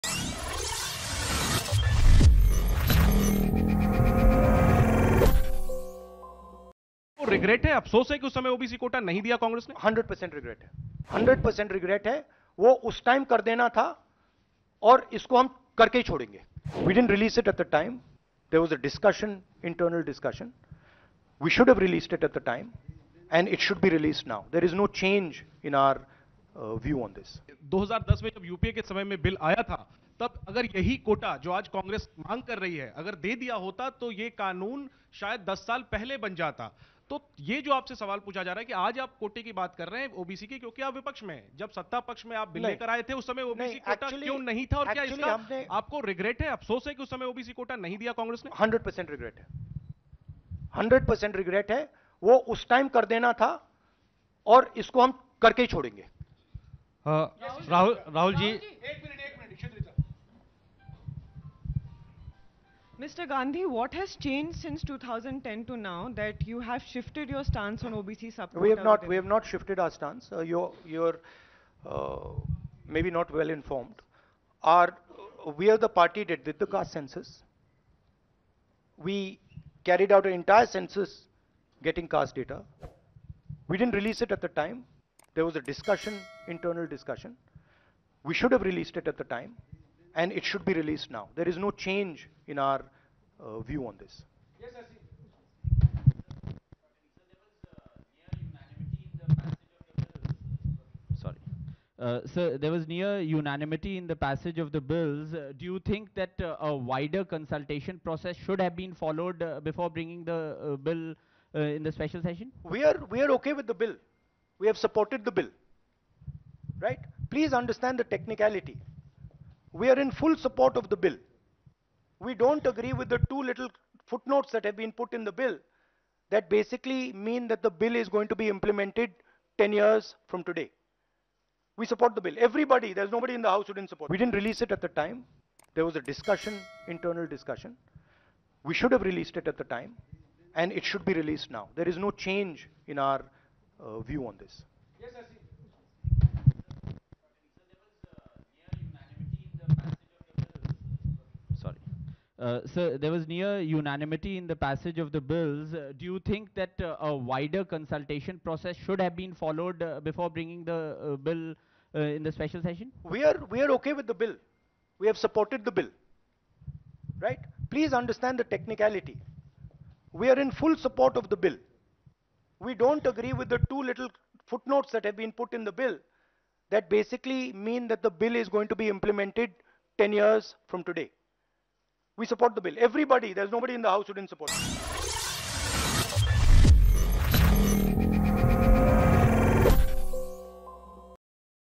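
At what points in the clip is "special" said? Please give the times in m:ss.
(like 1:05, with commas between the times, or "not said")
1:51, 2:42.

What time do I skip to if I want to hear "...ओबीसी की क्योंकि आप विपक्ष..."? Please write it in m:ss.
0:40.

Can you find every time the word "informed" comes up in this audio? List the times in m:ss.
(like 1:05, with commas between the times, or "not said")
1:13.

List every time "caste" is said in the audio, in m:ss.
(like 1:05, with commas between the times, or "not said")
1:16, 1:22.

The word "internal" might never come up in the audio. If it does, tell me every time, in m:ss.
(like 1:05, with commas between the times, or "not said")
1:26, 2:16.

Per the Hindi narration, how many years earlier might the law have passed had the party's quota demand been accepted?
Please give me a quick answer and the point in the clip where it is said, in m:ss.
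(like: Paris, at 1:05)
10 years, at 0:35.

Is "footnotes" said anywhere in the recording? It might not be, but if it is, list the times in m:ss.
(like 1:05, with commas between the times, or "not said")
2:04, 2:54.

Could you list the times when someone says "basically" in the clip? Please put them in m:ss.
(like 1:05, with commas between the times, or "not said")
2:06, 2:56.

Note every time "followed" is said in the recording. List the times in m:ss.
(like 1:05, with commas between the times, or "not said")
1:48, 2:39.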